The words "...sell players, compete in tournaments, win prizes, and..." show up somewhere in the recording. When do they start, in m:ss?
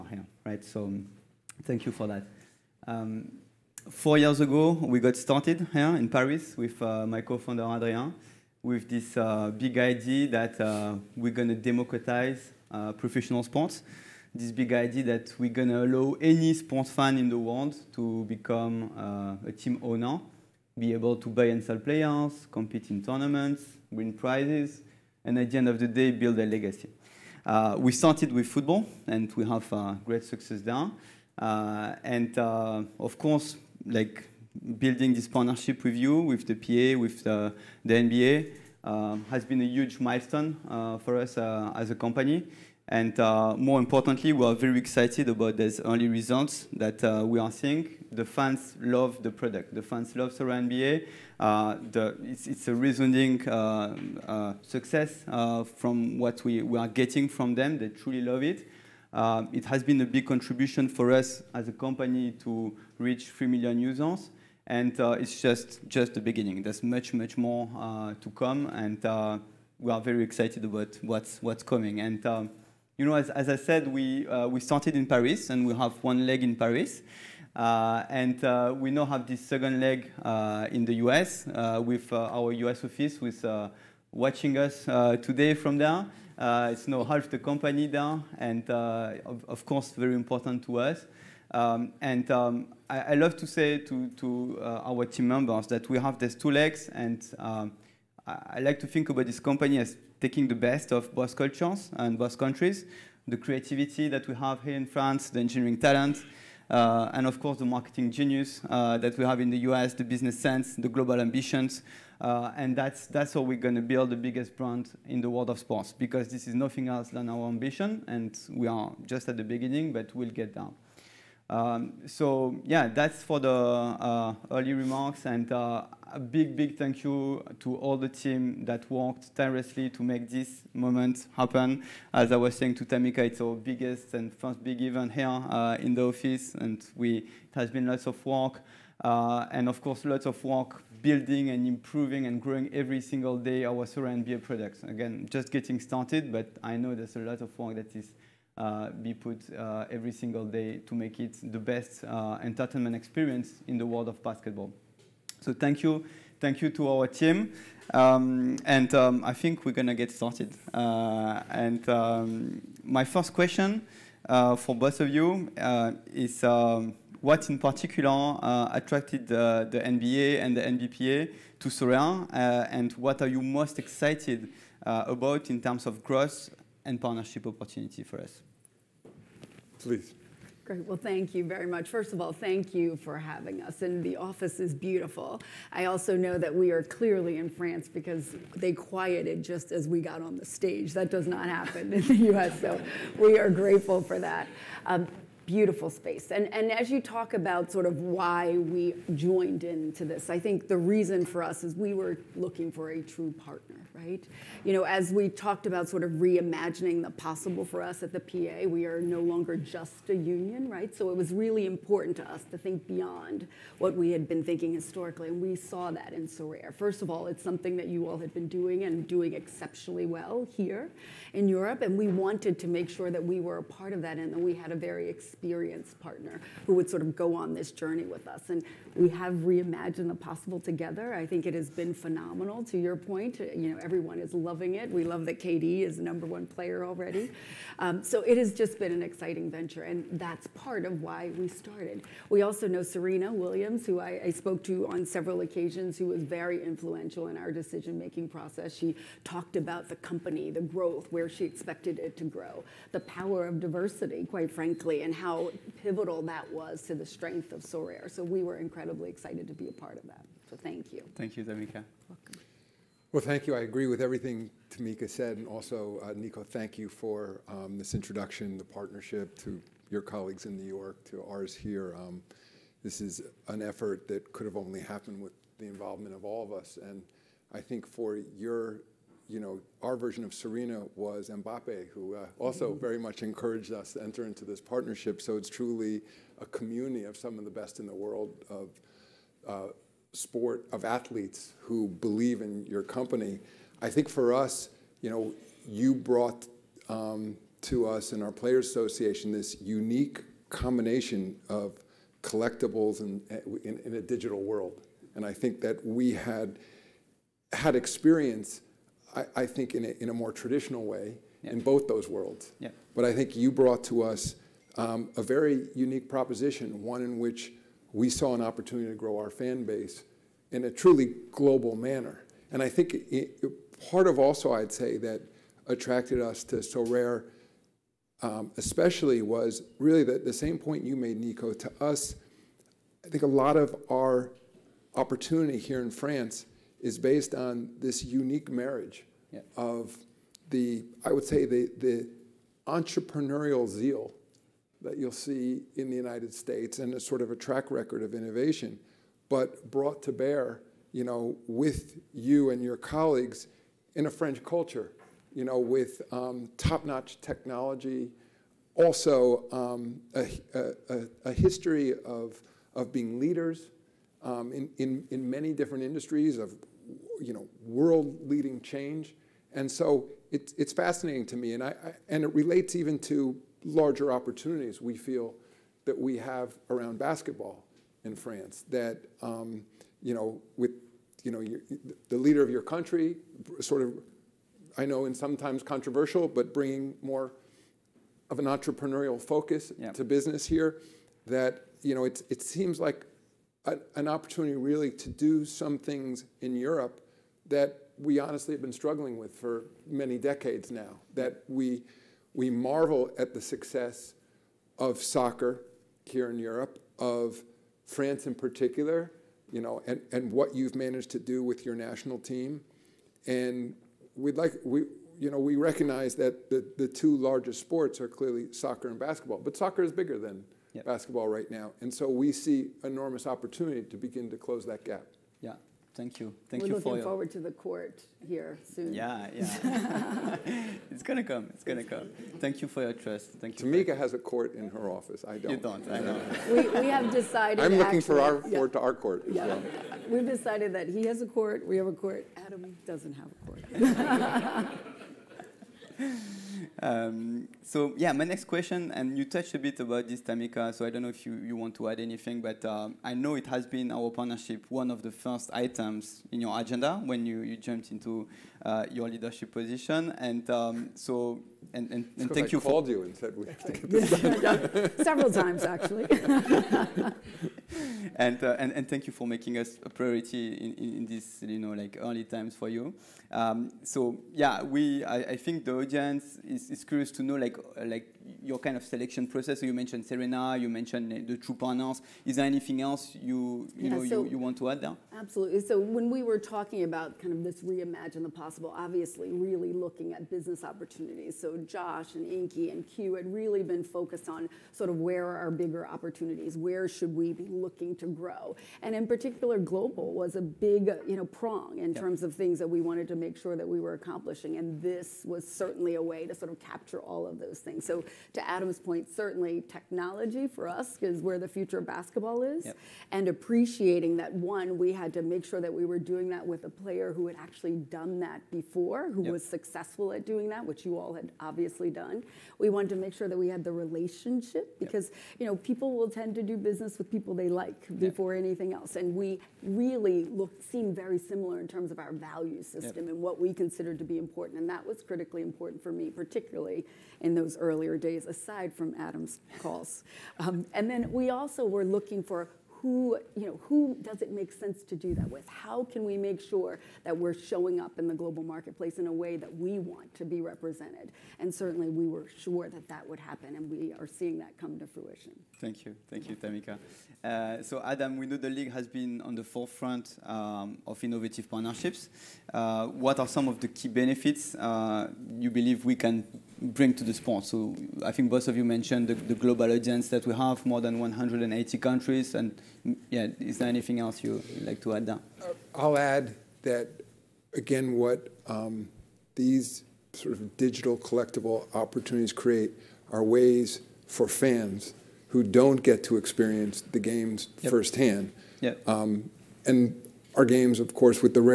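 0:21.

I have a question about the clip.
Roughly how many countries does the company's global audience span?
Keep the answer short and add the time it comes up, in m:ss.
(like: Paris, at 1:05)
More than 180, at 9:30.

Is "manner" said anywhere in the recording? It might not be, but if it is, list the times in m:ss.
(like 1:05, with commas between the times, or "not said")
5:21.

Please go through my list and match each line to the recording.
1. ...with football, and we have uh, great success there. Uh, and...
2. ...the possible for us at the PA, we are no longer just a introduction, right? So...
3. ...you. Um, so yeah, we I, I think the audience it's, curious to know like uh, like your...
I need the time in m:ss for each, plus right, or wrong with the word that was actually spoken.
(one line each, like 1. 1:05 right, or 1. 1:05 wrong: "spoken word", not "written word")
1. 0:28 right
2. 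3:27 wrong: "union", not "introduction"
3. 7:52 right.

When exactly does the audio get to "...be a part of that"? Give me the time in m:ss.
4:19.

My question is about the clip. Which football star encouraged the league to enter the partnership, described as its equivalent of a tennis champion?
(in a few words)
Mbappe.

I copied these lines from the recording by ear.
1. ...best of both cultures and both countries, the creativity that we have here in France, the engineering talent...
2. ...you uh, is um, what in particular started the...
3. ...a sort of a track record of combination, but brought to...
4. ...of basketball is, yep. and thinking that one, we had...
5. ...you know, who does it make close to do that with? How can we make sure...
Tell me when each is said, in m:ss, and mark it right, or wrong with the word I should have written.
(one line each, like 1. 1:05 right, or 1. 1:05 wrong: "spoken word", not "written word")
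1. 1:40 right
2. 2:45 wrong: "attracted", not "started"
3. 5:46 wrong: "innovation", not "combination"
4. 8:31 wrong: "appreciating", not "thinking"
5. 9:03 wrong: "sense", not "close".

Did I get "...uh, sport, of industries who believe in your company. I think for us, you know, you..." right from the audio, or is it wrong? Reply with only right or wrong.
wrong.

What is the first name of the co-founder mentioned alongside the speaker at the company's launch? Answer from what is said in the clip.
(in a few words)
Adrien.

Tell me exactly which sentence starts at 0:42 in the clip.
And more importantly, we are very excited about these early results that we are seeing.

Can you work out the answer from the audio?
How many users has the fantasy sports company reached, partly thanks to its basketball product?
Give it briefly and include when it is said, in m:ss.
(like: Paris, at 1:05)
3 million, at 1:03.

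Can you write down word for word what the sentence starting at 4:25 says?
And also, uh, Nico, thank you for um, this introduction, the partnership to your colleagues in New York, to ours here.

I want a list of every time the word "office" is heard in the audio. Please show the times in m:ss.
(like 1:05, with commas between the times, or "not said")
1:22, 2:16, 3:04, 7:14.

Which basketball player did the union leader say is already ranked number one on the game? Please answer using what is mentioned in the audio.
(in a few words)
KD.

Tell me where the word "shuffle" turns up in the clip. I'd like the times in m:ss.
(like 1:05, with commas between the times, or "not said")
not said.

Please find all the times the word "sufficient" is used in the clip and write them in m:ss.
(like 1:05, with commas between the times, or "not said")
not said.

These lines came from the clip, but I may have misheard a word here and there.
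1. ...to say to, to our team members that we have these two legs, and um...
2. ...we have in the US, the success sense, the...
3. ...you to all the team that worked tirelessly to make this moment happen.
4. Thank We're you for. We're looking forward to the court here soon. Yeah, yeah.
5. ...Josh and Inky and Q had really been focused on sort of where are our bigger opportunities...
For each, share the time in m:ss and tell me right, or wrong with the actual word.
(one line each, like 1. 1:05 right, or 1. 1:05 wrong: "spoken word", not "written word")
1. 1:33 right
2. 1:49 wrong: "business", not "success"
3. 2:07 right
4. 7:06 right
5. 8:11 right.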